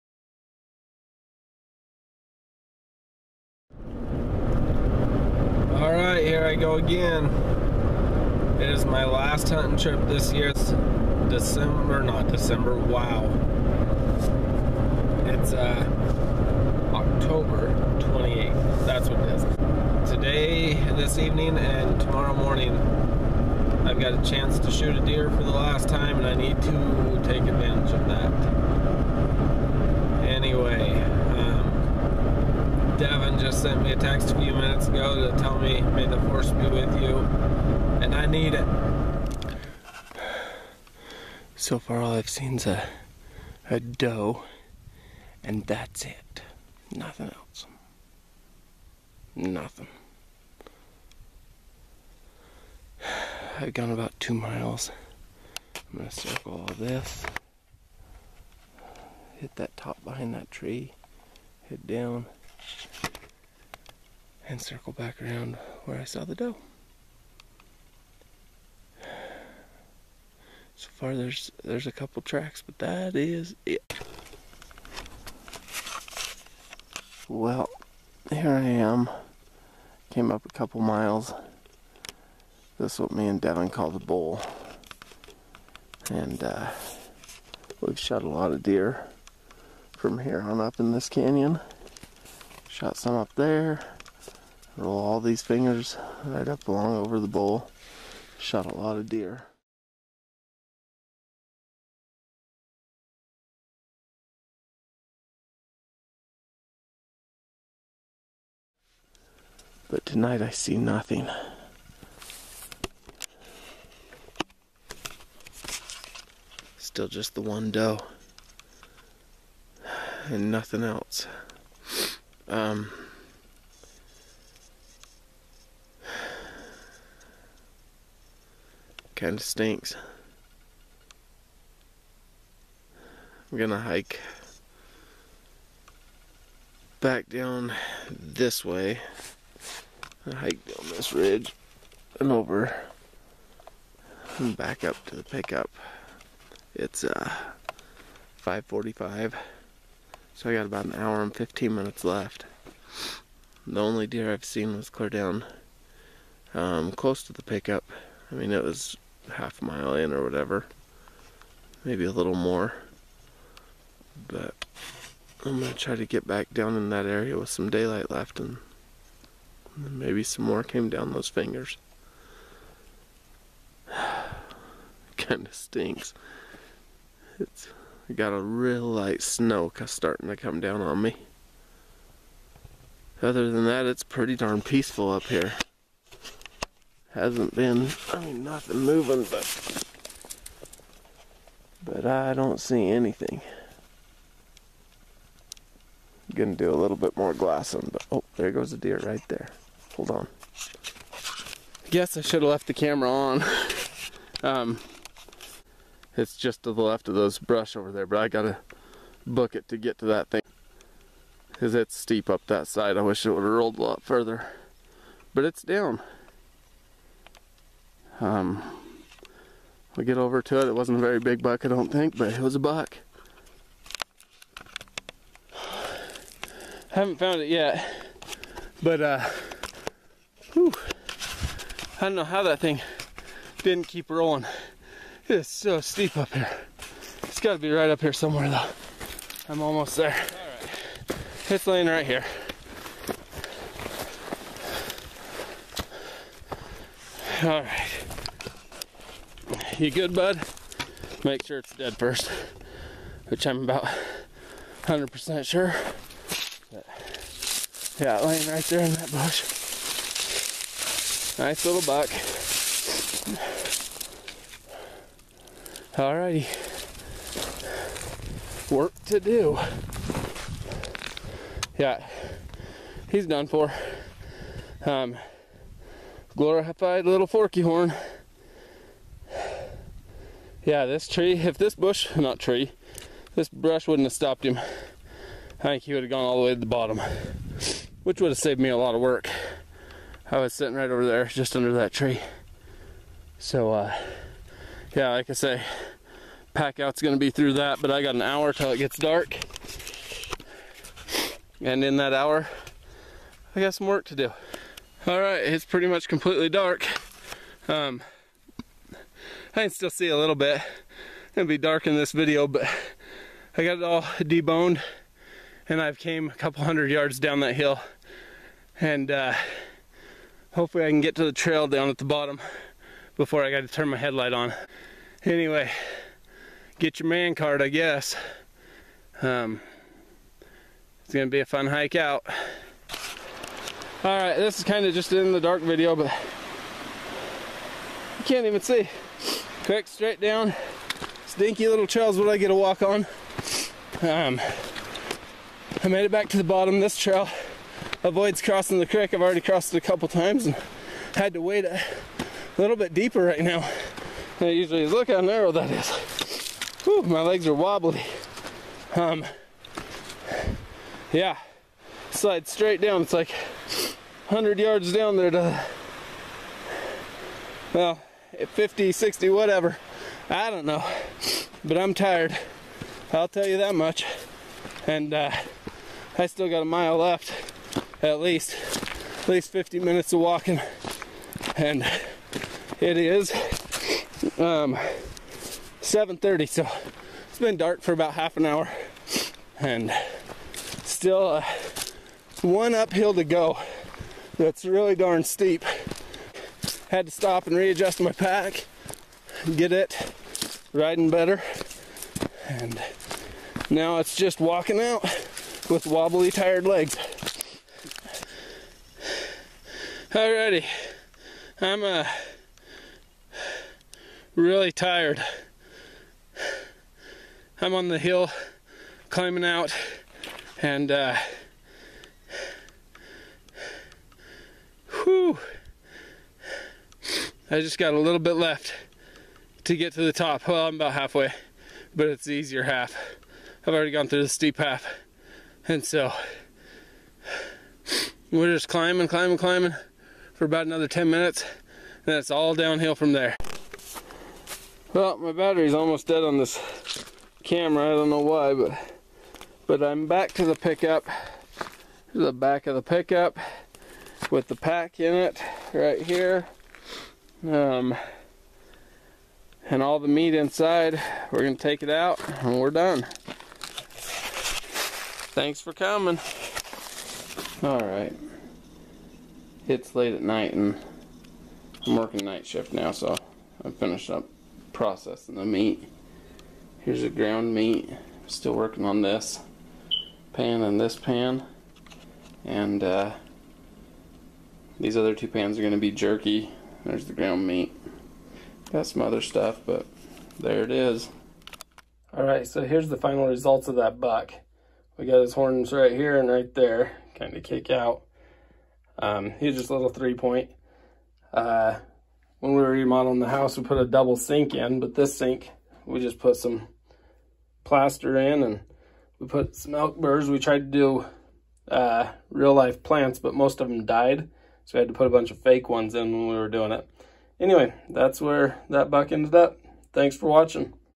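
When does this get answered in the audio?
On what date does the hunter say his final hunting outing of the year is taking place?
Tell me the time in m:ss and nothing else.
0:16.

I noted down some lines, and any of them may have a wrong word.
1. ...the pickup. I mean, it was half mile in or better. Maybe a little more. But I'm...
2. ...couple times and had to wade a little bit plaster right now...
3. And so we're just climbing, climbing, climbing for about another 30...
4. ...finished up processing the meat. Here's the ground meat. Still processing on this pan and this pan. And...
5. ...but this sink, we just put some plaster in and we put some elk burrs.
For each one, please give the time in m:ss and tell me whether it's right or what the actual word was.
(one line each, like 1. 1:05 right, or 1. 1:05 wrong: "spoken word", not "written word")
1. 2:37 wrong: "whatever", not "better"
2. 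5:49 wrong: "deeper", not "plaster"
3. 7:15 wrong: "10", not "30"
4. 7:53 wrong: "working", not "processing"
5. 8:24 right.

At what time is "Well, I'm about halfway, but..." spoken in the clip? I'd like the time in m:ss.
7:10.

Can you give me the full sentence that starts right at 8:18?
Um, he's just a little three point.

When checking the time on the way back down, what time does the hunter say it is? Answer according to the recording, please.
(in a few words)
5:45.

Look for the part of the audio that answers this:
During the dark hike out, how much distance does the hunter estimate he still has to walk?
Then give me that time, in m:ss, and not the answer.
6:16.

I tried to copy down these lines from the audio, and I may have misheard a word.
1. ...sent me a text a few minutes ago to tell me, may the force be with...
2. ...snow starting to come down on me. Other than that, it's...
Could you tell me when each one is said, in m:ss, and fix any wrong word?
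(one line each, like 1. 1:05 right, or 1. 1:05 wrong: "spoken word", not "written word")
1. 0:33 right
2. 2:59 right.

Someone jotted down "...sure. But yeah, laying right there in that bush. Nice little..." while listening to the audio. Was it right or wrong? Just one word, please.
right.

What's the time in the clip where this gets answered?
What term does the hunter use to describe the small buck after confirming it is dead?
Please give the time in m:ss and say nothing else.
4:37.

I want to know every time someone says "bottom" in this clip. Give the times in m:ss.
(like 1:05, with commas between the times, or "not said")
4:46, 5:22, 5:46.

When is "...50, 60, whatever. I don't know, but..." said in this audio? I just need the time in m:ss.
6:08.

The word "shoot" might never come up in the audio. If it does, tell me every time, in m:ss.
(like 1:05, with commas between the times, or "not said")
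0:24.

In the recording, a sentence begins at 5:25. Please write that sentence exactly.
Anyway, get your man card I guess.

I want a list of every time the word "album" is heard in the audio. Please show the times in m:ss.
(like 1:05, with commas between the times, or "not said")
not said.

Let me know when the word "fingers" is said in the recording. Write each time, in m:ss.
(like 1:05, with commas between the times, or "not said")
1:35, 2:51.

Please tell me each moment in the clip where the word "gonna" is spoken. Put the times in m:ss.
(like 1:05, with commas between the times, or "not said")
0:55, 2:13, 3:16, 4:57, 5:31.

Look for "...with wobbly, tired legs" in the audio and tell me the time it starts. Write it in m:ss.
6:45.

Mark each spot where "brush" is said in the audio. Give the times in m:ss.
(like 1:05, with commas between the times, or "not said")
3:27, 4:43.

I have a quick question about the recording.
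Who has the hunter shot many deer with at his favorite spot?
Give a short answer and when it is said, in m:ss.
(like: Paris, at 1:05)
Devin, at 1:23.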